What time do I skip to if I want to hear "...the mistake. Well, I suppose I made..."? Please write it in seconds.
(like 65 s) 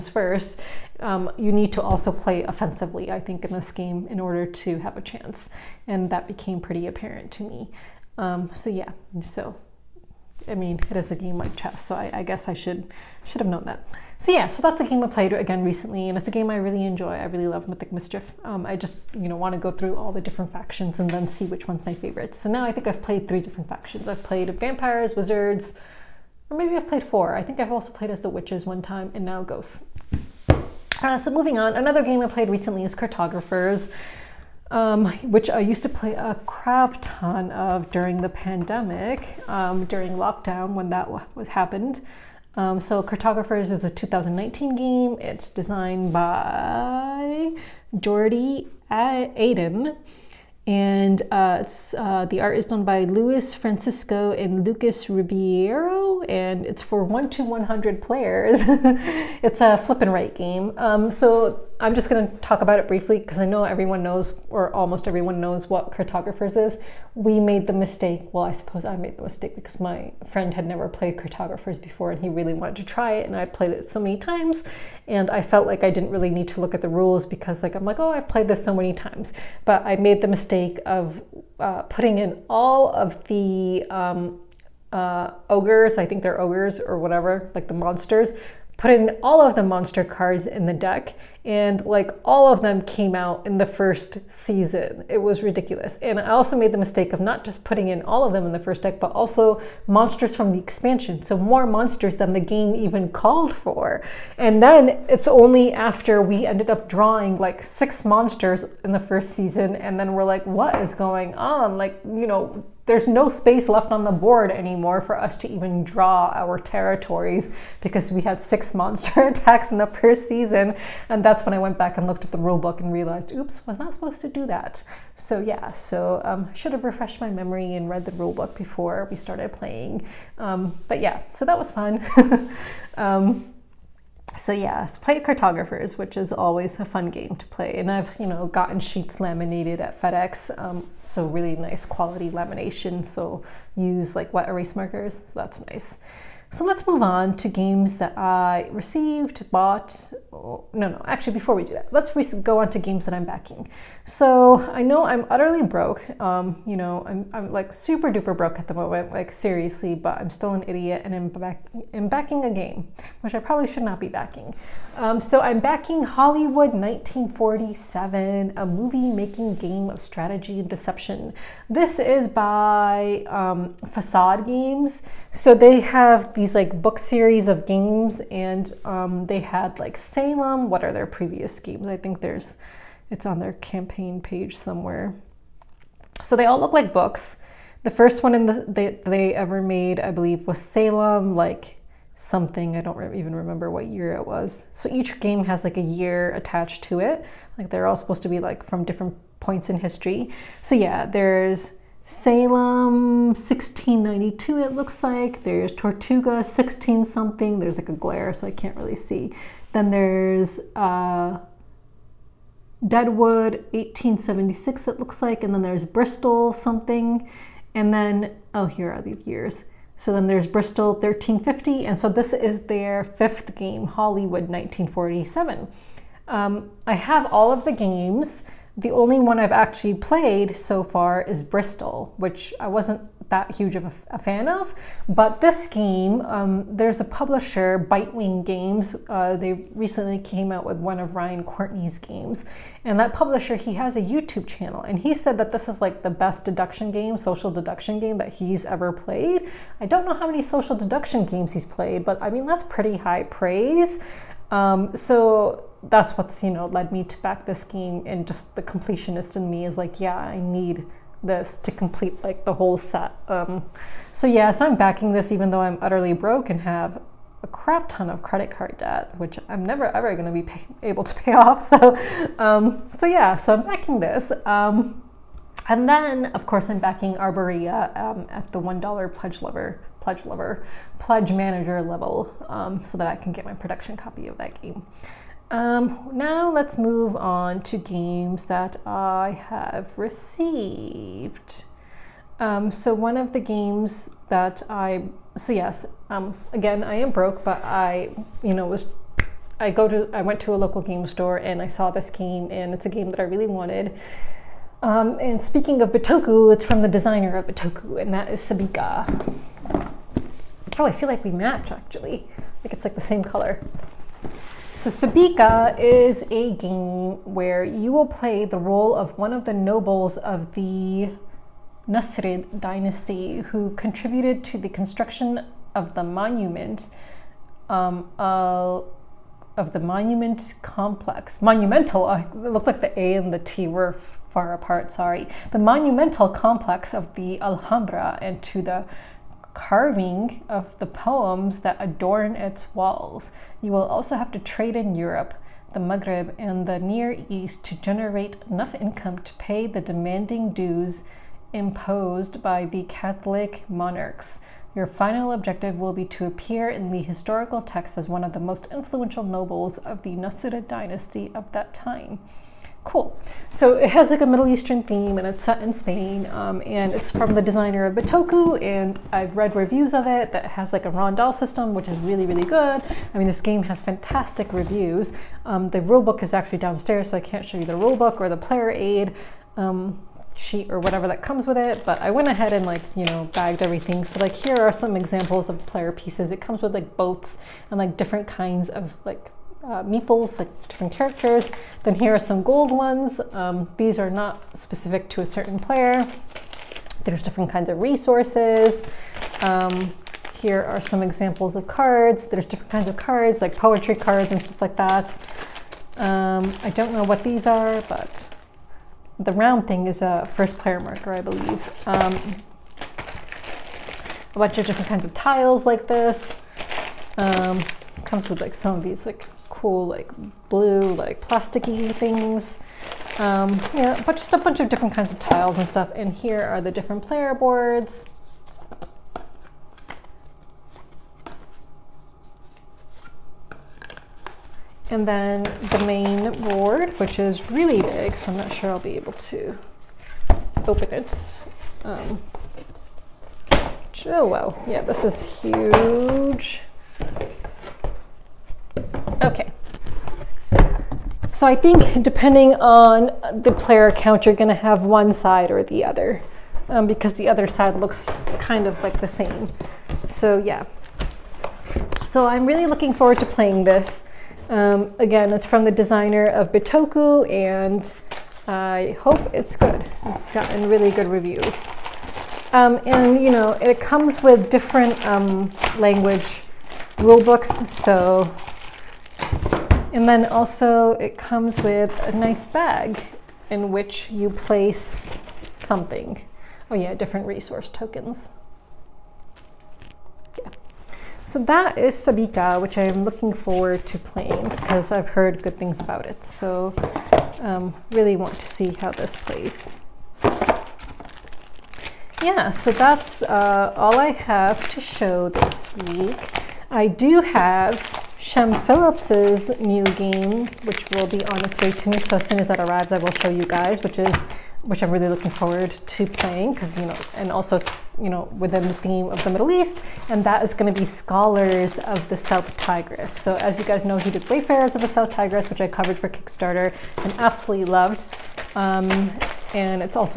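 67 s.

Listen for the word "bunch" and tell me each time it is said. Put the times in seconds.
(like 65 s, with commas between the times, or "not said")
414 s, 424 s.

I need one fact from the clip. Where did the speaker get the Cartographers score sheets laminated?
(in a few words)
FedEx.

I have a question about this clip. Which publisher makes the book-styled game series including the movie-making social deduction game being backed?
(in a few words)
Facade Games.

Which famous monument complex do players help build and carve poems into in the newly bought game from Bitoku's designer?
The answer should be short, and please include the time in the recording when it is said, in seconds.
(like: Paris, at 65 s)
The Alhambra, at 337 s.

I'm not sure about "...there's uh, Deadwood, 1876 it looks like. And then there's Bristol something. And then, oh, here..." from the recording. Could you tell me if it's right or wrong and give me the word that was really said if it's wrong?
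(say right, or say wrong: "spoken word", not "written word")
right.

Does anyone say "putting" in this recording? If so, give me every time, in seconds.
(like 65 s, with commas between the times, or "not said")
81 s, 97 s.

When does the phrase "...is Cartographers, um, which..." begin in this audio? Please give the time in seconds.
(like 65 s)
32 s.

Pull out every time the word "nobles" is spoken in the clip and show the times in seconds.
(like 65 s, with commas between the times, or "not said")
319 s, 359 s.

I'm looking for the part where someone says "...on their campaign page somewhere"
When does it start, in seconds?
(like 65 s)
183 s.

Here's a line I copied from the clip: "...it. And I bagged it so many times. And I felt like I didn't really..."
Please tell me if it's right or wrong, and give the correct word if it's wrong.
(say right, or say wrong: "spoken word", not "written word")
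wrong: "played", not "bagged".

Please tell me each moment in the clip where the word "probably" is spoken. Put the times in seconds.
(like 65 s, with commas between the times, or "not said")
163 s.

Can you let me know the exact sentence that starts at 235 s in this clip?
But this game, um, there's a publisher, Bitewing Games.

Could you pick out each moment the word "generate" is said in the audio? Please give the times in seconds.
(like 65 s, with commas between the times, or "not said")
347 s.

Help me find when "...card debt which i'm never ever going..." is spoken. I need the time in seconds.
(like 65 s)
268 s.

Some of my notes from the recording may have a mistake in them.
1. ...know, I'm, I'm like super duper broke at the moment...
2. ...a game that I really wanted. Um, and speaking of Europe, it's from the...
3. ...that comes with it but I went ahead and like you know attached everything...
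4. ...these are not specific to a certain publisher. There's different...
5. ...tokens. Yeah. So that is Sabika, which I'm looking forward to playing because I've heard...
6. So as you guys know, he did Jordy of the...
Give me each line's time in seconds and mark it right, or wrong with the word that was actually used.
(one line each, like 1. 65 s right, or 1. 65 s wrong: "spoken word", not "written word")
1. 156 s right
2. 302 s wrong: "Bitoku", not "Europe"
3. 381 s wrong: "bagged", not "attached"
4. 393 s wrong: "player", not "publisher"
5. 487 s right
6. 523 s wrong: "Wayfarers", not "Jordy".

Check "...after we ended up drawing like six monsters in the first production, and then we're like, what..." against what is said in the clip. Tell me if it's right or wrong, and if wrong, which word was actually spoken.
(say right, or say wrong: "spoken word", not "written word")
wrong: "season", not "production".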